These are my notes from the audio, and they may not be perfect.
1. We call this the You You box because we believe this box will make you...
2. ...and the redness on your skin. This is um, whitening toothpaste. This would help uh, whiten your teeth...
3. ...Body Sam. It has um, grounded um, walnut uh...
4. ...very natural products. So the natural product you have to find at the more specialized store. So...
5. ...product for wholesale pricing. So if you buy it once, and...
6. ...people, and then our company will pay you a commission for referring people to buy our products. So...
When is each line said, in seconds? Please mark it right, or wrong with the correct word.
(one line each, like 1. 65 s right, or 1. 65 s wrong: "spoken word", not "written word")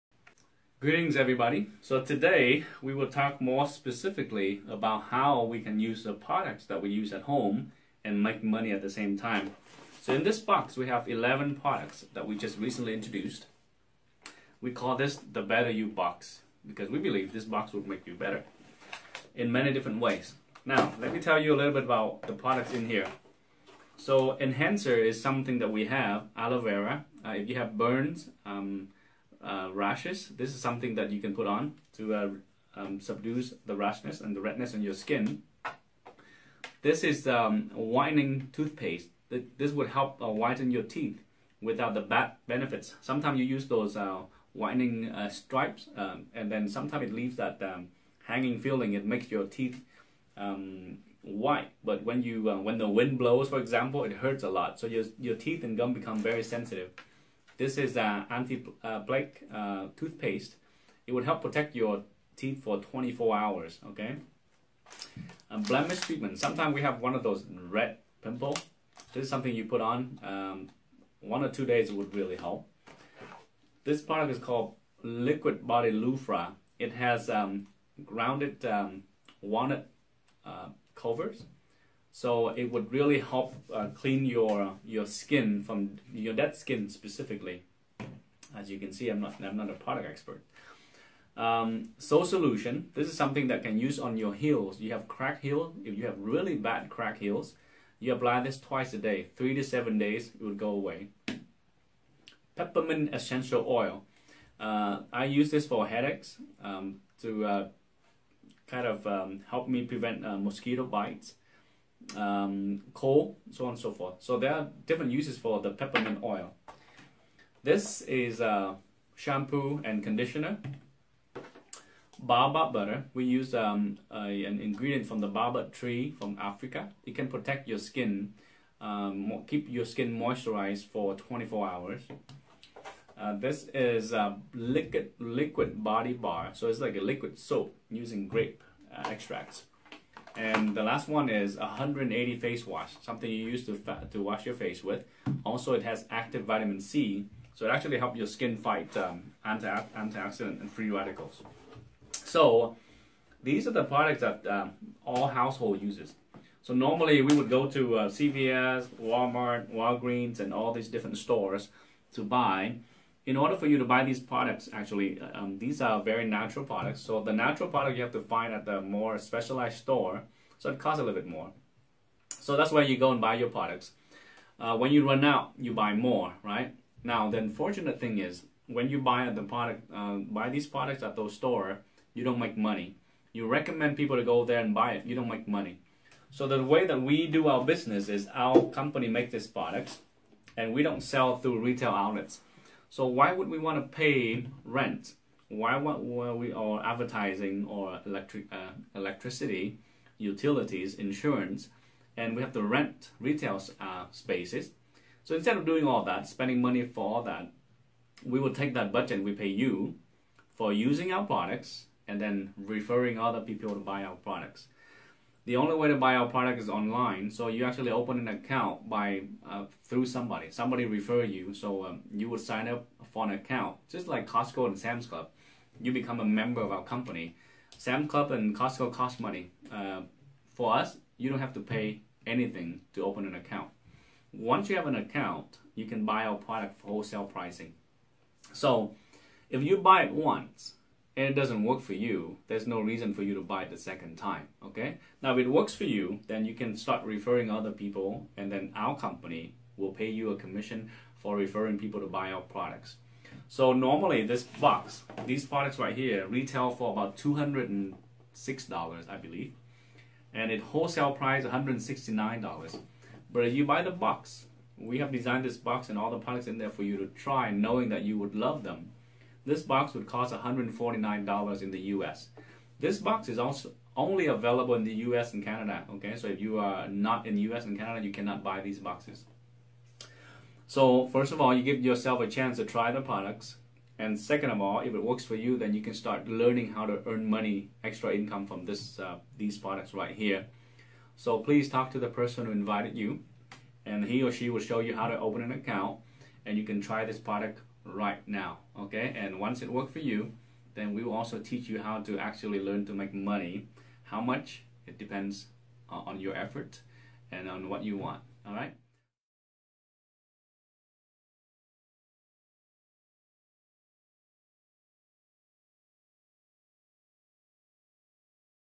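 1. 14 s wrong: "Better", not "You"
2. 34 s right
3. 75 s wrong: "Lufra", not "Sam"
4. 166 s right
5. 236 s right
6. 247 s right.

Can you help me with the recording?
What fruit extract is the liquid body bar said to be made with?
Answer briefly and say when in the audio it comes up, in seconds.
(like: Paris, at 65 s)
grape, at 138 s.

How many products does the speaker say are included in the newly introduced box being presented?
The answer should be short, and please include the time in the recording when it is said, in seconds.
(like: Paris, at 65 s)
11, at 11 s.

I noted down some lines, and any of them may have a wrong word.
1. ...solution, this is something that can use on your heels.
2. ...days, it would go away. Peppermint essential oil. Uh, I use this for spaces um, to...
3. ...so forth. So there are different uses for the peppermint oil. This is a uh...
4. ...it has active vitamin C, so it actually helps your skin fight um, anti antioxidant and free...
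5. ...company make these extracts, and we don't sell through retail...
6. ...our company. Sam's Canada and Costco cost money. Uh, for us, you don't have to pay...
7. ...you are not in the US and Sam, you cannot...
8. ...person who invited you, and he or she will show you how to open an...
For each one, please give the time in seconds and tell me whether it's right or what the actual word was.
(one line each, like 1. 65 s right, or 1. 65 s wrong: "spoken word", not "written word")
1. 92 s right
2. 99 s wrong: "headaches", not "spaces"
3. 113 s right
4. 145 s right
5. 188 s wrong: "products", not "extracts"
6. 226 s wrong: "Club", not "Canada"
7. 276 s wrong: "Canada", not "Sam"
8. 292 s right.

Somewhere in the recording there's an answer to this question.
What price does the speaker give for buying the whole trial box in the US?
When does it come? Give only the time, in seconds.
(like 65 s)
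270 s.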